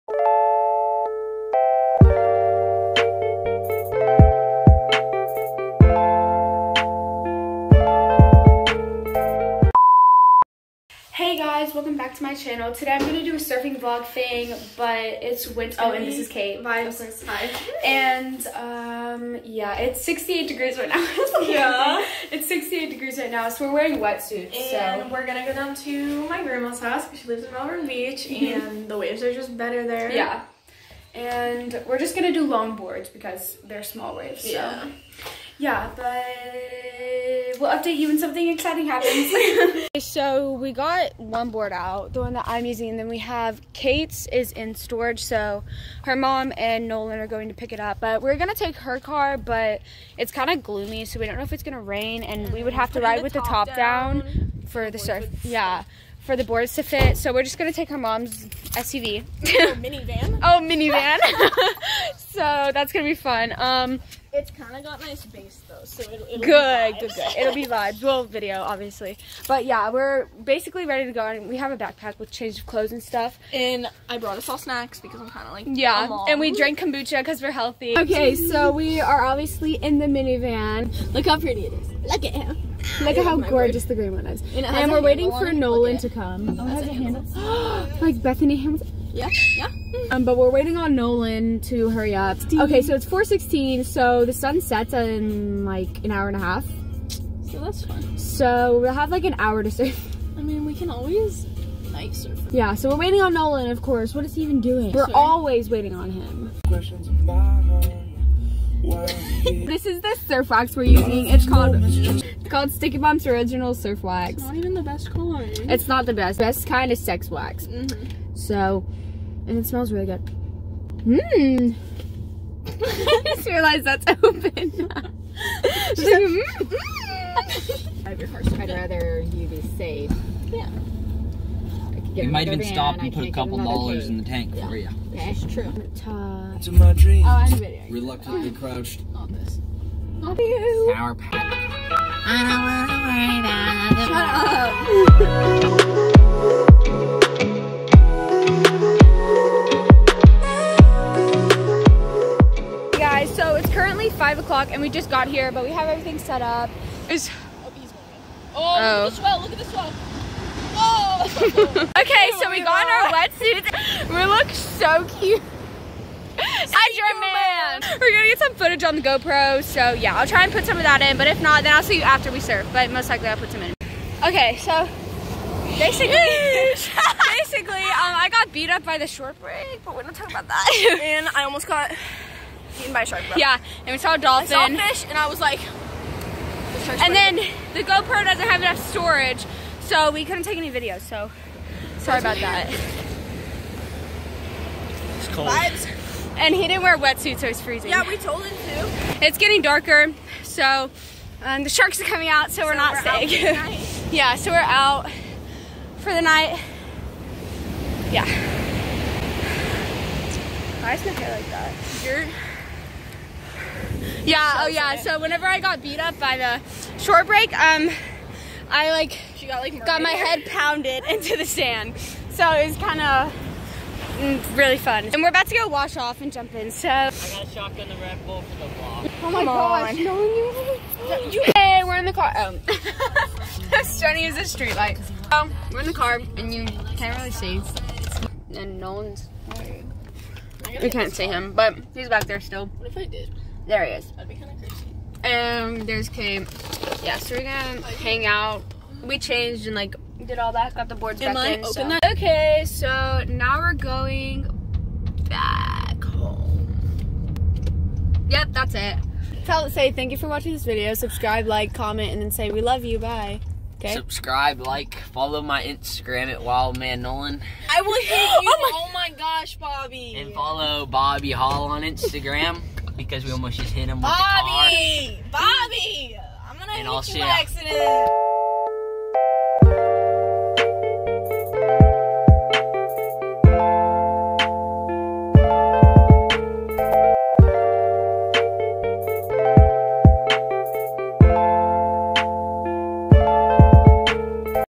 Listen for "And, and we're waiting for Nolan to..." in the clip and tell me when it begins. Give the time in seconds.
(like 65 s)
84 s.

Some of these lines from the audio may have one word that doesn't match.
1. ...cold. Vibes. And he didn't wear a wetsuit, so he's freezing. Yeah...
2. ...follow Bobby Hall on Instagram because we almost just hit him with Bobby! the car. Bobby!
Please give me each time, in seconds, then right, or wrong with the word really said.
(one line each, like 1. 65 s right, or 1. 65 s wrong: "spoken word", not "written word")
1. 195 s right
2. 270 s right.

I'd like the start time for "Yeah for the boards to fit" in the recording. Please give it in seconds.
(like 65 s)
55 s.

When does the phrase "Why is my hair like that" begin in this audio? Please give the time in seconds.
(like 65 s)
210 s.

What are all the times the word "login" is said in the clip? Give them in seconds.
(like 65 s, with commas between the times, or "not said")
not said.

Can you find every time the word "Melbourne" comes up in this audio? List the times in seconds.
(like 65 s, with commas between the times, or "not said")
27 s.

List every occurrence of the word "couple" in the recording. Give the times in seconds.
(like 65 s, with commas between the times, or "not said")
133 s.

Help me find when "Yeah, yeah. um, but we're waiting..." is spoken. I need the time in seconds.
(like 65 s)
89 s.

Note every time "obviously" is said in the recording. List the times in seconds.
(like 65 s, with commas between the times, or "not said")
68 s, 79 s.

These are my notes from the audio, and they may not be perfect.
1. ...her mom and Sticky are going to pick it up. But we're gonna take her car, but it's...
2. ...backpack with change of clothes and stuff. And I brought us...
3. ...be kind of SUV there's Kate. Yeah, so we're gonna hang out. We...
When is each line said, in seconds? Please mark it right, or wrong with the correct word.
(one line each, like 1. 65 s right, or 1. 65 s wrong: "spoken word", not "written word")
1. 46 s wrong: "Nolan", not "Sticky"
2. 71 s right
3. 244 s wrong: "And", not "SUV".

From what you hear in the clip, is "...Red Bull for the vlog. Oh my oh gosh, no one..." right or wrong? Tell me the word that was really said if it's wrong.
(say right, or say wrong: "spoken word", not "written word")
right.